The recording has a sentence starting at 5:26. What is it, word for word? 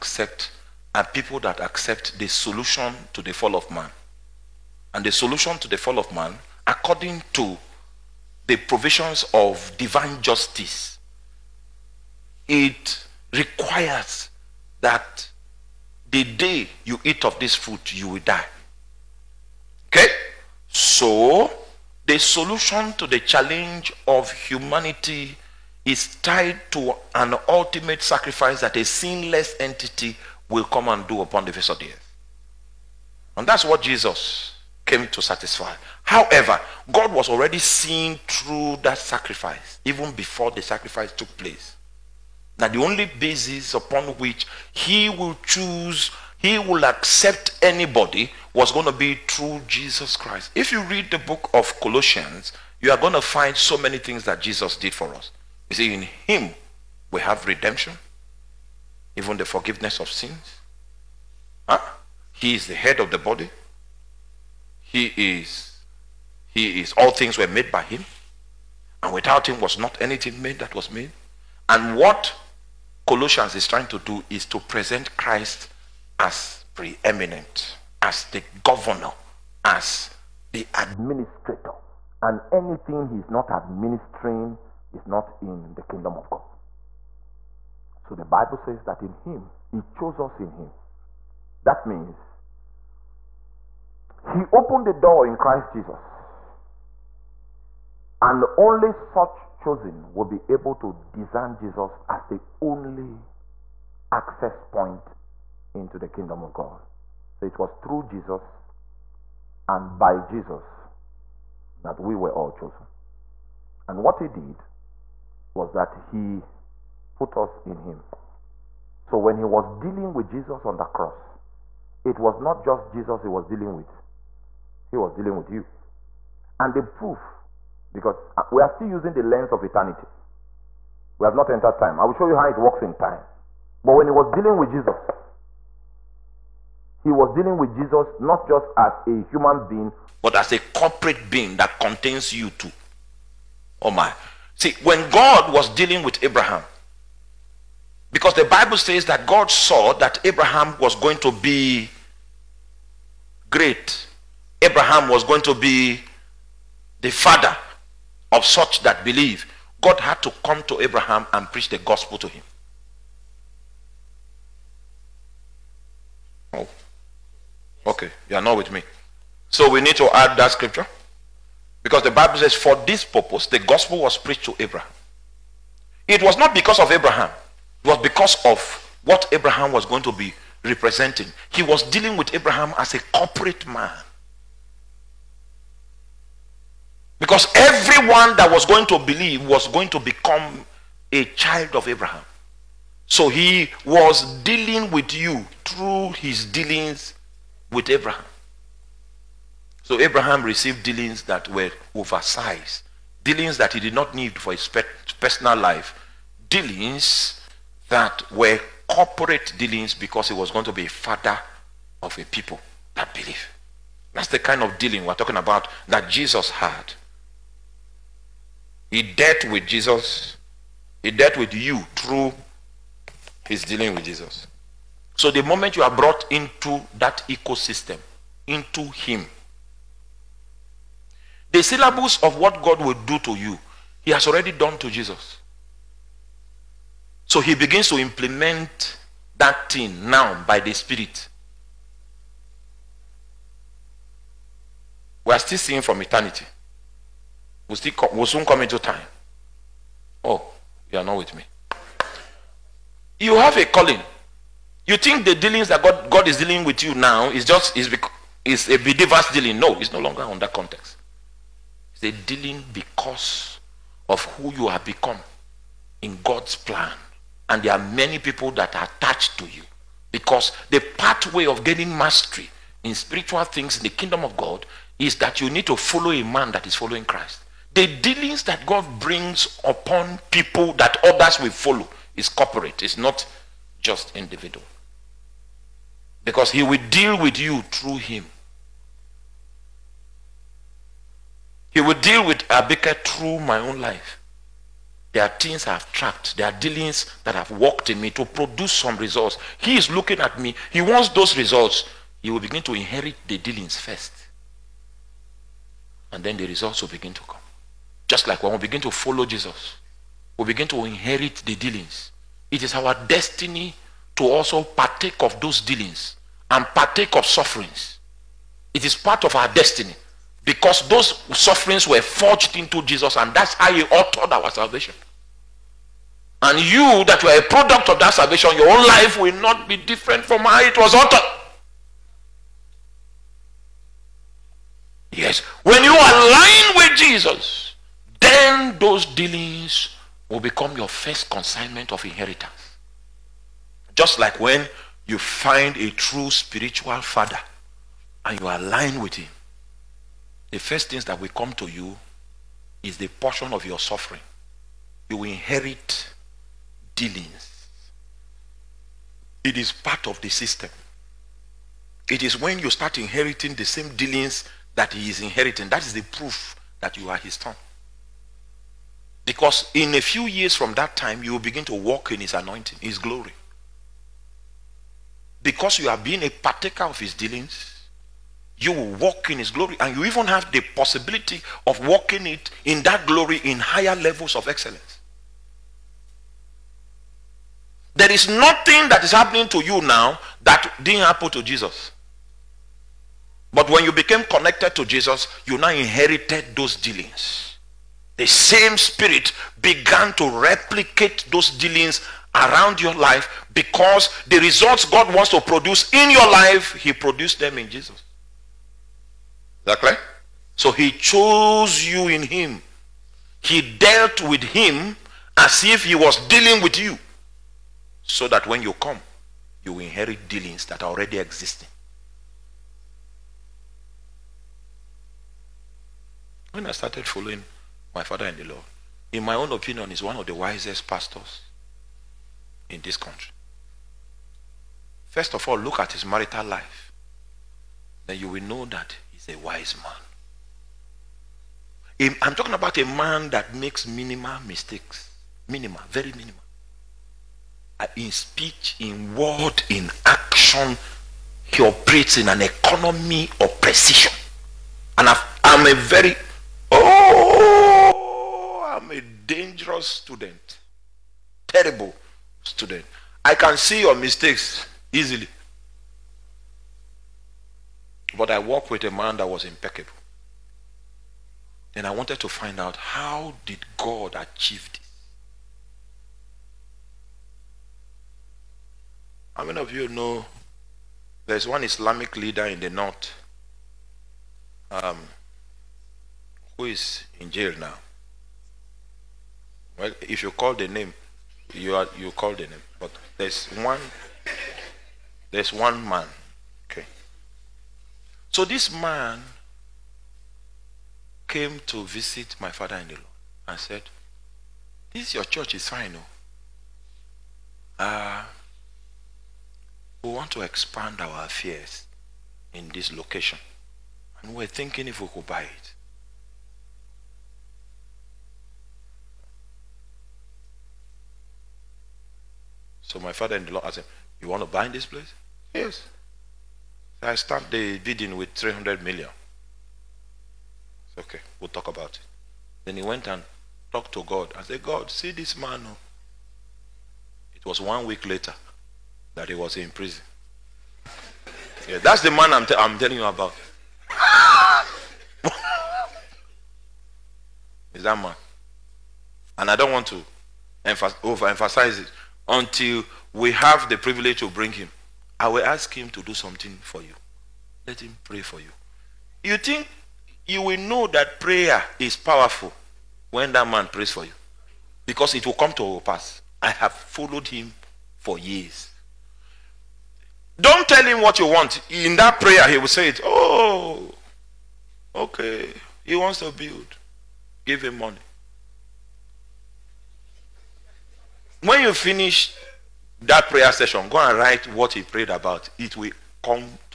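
And you, that were a product of that salvation, your own life will not be different from how it was authored.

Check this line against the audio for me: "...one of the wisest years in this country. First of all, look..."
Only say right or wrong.
wrong.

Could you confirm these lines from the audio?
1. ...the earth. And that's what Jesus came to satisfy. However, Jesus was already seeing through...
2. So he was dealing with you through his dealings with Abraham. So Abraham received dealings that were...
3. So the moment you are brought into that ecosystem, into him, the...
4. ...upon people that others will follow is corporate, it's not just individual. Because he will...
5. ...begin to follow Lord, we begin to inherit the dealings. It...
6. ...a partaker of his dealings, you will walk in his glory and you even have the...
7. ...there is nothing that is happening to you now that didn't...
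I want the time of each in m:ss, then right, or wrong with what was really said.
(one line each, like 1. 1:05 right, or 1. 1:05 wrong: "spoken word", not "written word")
1. 0:31 wrong: "God", not "Jesus"
2. 3:13 right
3. 3:45 right
4. 4:39 right
5. 5:08 wrong: "Jesus", not "Lord"
6. 6:16 right
7. 6:27 right.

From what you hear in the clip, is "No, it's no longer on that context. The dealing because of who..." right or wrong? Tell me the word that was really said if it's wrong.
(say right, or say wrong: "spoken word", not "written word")
right.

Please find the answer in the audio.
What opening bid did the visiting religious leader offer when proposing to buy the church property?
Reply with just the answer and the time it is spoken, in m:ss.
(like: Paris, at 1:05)
300 million, at 8:48.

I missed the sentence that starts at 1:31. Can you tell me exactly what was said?
That means he opened the door in Christ Jesus.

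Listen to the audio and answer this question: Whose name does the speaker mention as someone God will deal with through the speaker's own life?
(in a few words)
Abika.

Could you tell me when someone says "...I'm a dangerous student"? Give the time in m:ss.
7:38.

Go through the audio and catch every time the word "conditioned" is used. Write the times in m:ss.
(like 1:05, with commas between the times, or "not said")
not said.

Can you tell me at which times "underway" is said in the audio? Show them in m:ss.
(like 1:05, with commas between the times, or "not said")
not said.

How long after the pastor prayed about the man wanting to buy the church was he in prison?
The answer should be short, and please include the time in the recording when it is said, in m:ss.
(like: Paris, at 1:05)
one week, at 8:57.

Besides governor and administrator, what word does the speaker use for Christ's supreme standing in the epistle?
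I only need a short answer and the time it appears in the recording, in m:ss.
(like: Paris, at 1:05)
preeminent, at 1:16.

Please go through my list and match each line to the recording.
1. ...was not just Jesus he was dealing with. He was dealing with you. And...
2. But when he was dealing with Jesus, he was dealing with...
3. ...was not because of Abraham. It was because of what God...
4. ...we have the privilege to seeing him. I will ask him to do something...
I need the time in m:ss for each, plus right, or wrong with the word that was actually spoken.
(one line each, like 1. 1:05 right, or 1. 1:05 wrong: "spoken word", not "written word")
1. 2:02 right
2. 2:13 right
3. 2:56 wrong: "Abraham", not "God"
4. 9:13 wrong: "bring", not "seeing".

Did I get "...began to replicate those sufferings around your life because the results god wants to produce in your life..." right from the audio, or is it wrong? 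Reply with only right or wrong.
wrong.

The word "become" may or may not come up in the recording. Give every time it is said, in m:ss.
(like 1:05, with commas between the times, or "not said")
3:09, 4:24, 5:40.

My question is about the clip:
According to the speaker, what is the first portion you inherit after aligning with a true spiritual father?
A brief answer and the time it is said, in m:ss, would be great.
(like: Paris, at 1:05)
suffering, at 5:53.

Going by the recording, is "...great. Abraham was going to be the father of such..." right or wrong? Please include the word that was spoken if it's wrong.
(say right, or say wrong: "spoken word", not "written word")
right.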